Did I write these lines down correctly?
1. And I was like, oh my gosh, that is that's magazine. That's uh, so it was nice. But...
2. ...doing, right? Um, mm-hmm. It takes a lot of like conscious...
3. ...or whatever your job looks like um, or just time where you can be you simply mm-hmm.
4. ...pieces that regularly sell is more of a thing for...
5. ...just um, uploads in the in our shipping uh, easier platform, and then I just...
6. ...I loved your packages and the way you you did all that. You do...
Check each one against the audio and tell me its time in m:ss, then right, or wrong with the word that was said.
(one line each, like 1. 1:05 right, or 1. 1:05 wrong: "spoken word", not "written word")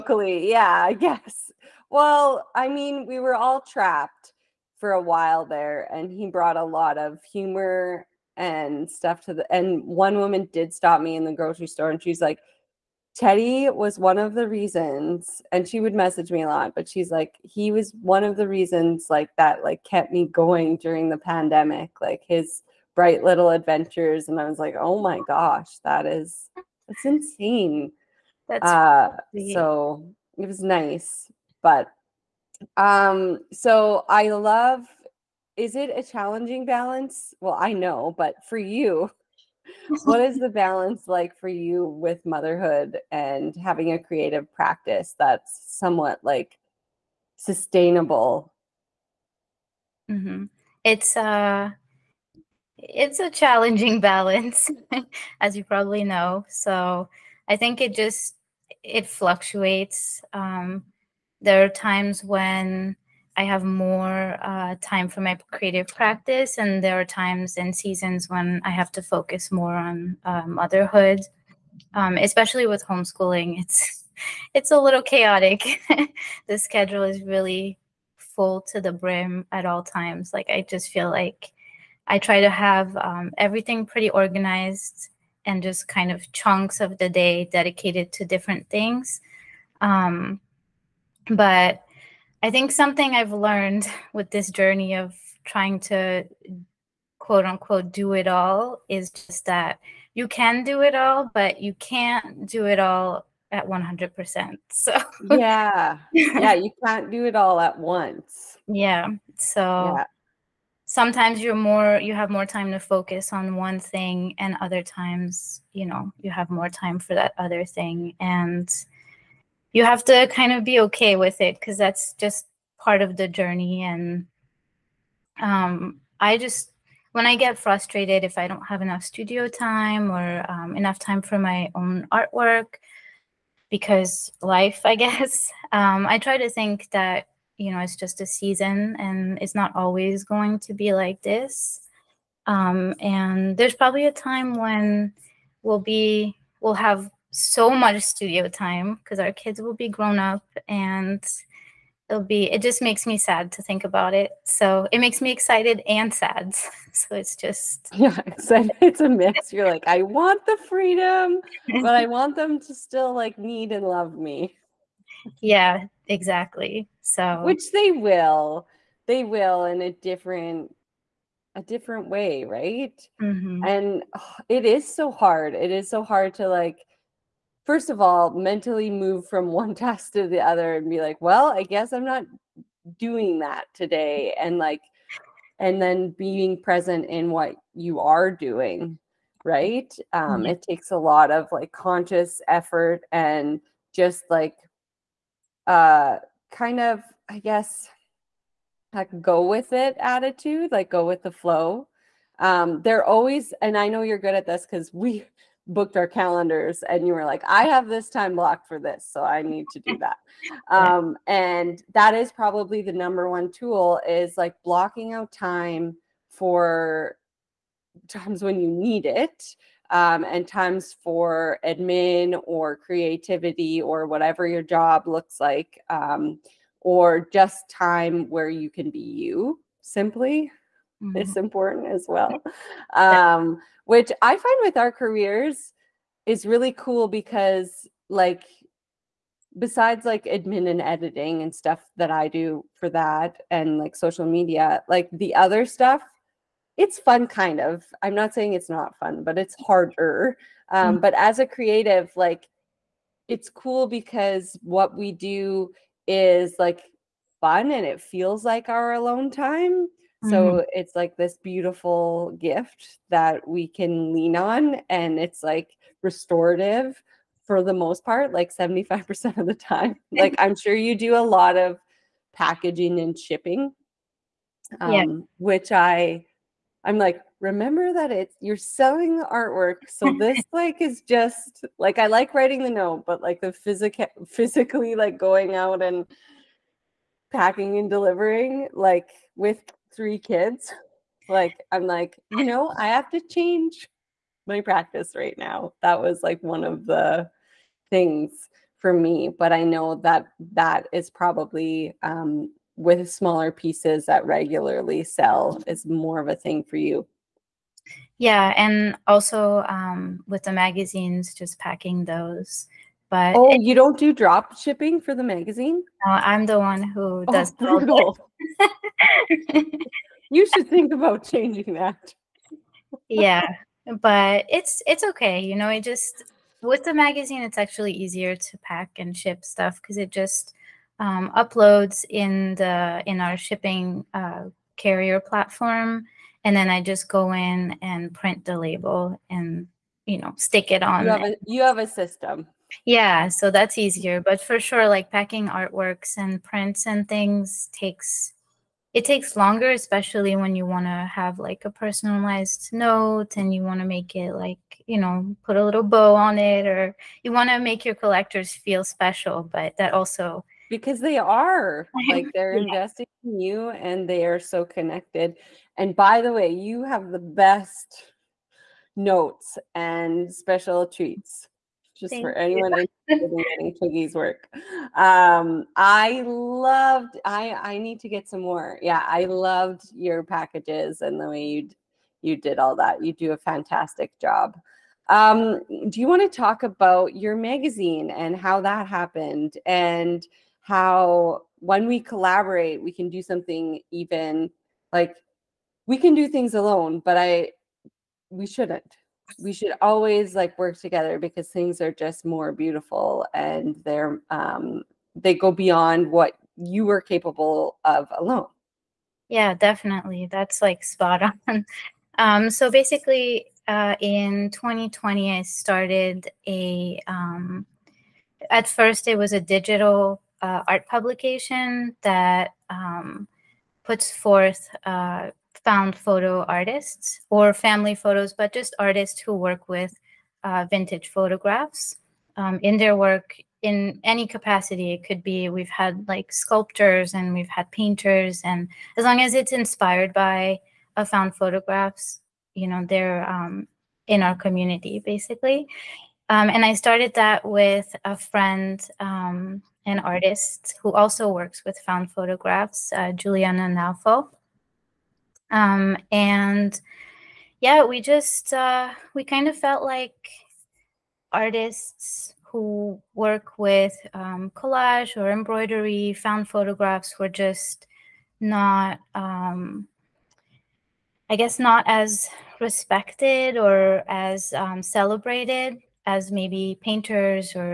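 1. 0:24 wrong: "insane", not "magazine"
2. 3:08 right
3. 3:43 right
4. 5:03 right
5. 5:30 wrong: "carrier", not "easier"
6. 6:19 right.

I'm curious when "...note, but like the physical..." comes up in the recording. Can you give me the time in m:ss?
4:42.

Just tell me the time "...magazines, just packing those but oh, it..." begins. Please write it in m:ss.
5:10.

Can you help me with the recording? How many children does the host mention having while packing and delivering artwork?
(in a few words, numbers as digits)
3.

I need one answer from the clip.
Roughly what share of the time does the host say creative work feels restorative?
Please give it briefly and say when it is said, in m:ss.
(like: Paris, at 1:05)
75%, at 4:28.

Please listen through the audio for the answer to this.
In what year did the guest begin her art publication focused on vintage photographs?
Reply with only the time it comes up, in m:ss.
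6:54.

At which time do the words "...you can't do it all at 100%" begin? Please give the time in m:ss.
1:41.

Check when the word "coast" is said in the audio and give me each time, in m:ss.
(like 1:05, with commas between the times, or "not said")
not said.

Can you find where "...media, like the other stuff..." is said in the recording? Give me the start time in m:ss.
4:04.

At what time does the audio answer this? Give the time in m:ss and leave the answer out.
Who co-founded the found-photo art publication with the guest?
7:33.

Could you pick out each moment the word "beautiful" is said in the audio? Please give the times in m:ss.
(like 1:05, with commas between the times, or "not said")
4:21, 6:42.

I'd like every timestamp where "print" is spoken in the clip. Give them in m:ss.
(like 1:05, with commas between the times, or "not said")
5:38, 5:46.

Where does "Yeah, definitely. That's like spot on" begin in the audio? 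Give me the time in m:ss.
6:49.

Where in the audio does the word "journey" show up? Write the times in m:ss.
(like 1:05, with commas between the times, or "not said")
1:34, 2:03.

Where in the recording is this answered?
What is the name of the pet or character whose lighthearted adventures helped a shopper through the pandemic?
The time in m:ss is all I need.
0:13.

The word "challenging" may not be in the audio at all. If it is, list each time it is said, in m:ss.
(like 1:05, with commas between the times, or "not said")
0:36, 0:53.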